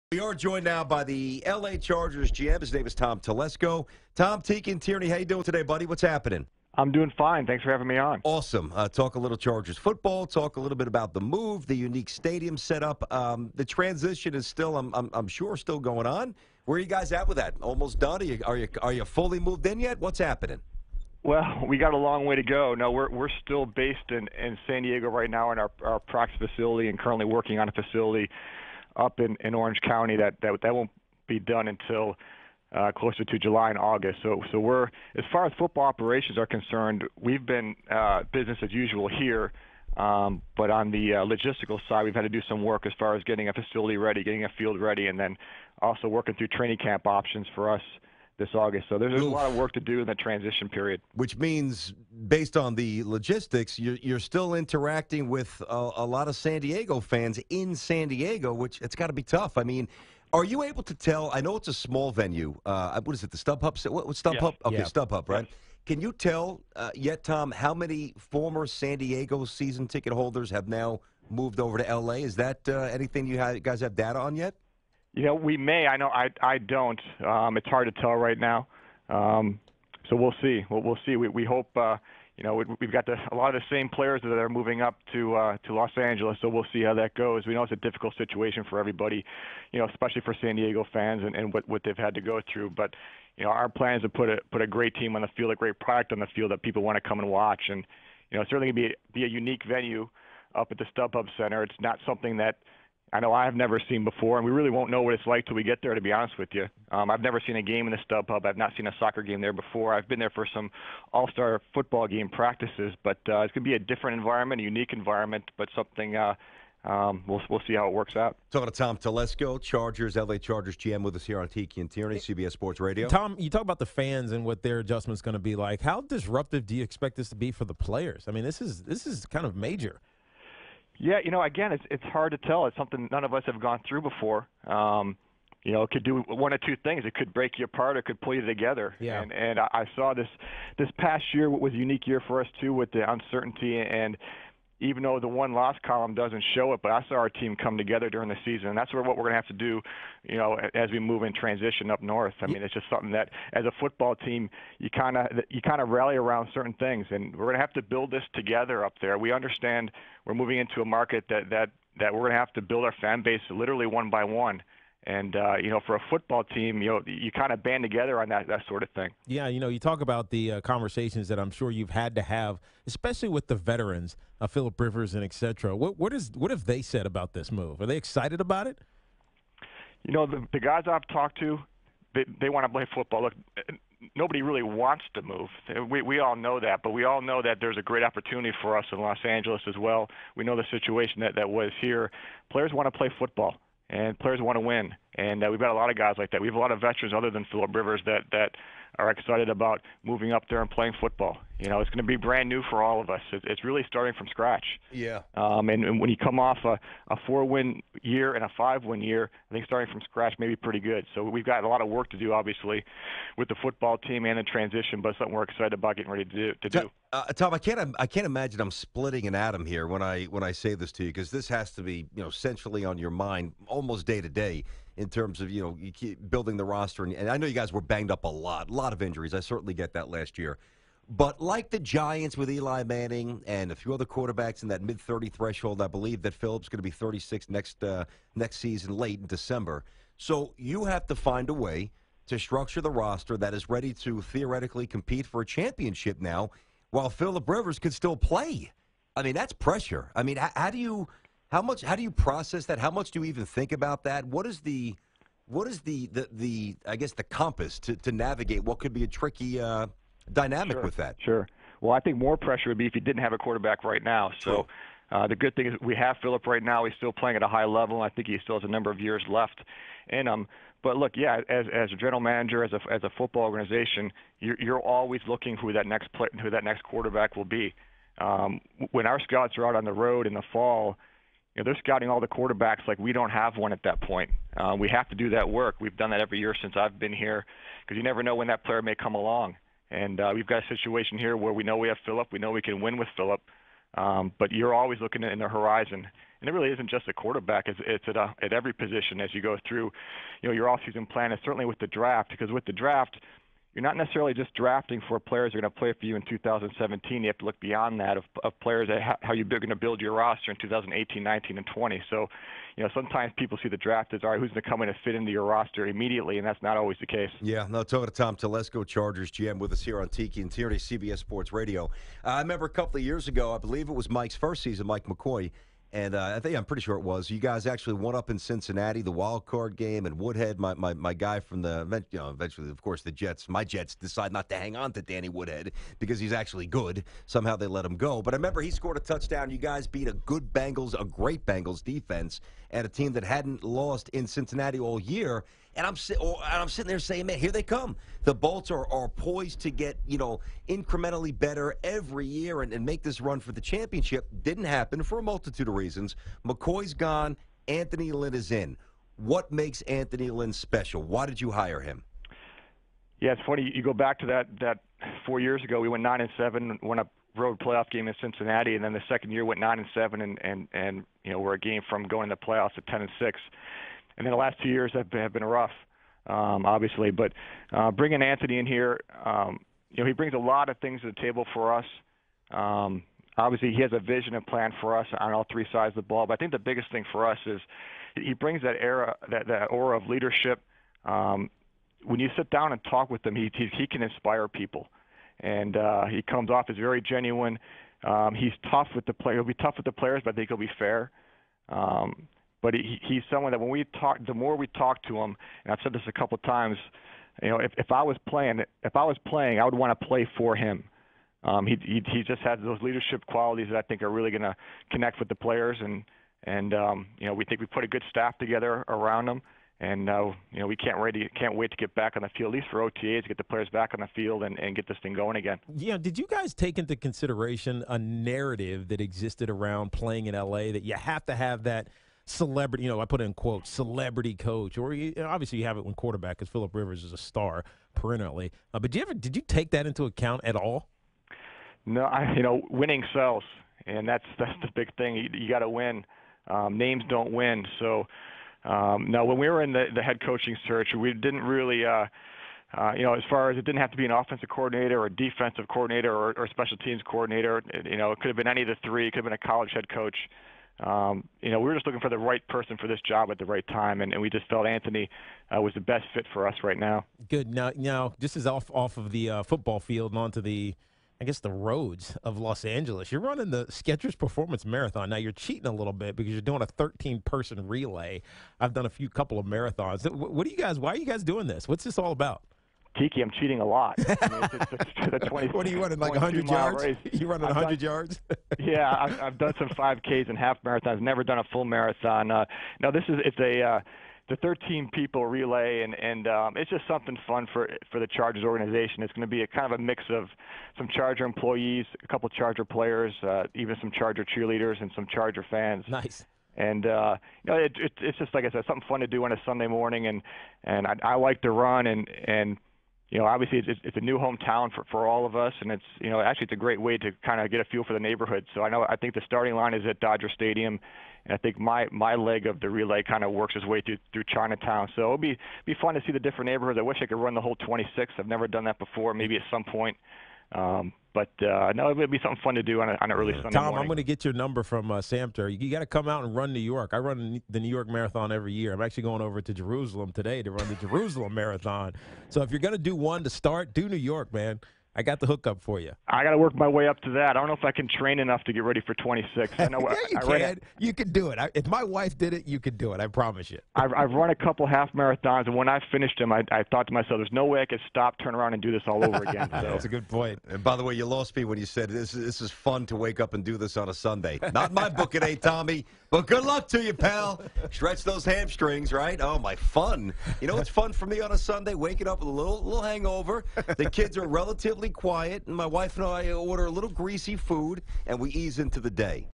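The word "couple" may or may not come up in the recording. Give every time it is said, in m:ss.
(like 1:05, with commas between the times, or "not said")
5:22, 6:46, 7:59, 8:22, 9:14.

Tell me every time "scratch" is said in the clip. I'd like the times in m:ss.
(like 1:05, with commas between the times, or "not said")
3:24, 3:30.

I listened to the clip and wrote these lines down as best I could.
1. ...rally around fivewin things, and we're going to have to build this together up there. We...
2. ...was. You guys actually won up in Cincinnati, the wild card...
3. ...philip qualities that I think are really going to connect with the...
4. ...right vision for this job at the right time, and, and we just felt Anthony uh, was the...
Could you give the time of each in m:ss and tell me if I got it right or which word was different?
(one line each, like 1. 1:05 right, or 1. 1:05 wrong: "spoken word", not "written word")
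1. 2:35 wrong: "certain", not "fivewin"
2. 5:27 right
3. 6:52 wrong: "leadership", not "philip"
4. 7:42 wrong: "person", not "vision".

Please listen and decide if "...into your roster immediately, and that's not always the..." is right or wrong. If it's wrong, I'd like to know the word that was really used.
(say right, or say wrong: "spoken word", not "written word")
right.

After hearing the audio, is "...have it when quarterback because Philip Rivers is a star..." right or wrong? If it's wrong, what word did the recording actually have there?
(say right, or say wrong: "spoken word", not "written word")
right.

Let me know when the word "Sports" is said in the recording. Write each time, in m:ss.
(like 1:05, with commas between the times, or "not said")
2:02, 5:21.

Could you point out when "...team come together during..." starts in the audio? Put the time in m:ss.
2:27.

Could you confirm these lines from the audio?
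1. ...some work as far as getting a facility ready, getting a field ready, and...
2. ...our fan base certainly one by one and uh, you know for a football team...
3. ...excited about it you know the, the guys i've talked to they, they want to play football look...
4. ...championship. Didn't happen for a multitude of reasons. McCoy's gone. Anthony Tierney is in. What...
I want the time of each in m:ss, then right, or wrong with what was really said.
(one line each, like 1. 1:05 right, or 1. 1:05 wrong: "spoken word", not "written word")
1. 0:42 right
2. 2:42 wrong: "literally", not "certainly"
3. 2:57 right
4. 5:53 wrong: "Lynn", not "Tierney".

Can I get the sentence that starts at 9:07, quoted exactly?
I don't know if I can train enough to get ready for 26.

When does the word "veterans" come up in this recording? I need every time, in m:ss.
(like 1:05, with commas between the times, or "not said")
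2:53, 3:16.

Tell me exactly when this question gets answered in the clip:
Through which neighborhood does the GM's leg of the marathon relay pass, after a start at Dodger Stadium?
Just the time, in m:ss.
8:44.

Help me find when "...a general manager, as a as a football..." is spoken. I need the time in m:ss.
4:31.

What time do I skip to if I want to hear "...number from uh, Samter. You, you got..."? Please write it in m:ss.
8:54.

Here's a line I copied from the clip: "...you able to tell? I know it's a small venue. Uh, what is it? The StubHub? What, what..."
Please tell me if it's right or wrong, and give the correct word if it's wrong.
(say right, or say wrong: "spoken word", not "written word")
right.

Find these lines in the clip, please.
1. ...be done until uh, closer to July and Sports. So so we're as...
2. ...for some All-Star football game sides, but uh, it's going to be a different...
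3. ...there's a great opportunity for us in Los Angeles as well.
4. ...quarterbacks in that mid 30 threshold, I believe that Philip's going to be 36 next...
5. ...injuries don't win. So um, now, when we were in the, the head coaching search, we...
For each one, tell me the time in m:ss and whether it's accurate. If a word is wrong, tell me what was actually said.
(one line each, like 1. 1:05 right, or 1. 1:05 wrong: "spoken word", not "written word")
1. 0:31 wrong: "August", not "Sports"
2. 1:50 wrong: "practices", not "sides"
3. 3:07 right
4. 3:54 right
5. 7:26 wrong: "names", not "injuries".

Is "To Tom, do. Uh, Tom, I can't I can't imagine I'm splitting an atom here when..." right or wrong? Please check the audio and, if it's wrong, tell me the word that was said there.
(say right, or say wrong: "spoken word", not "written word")
right.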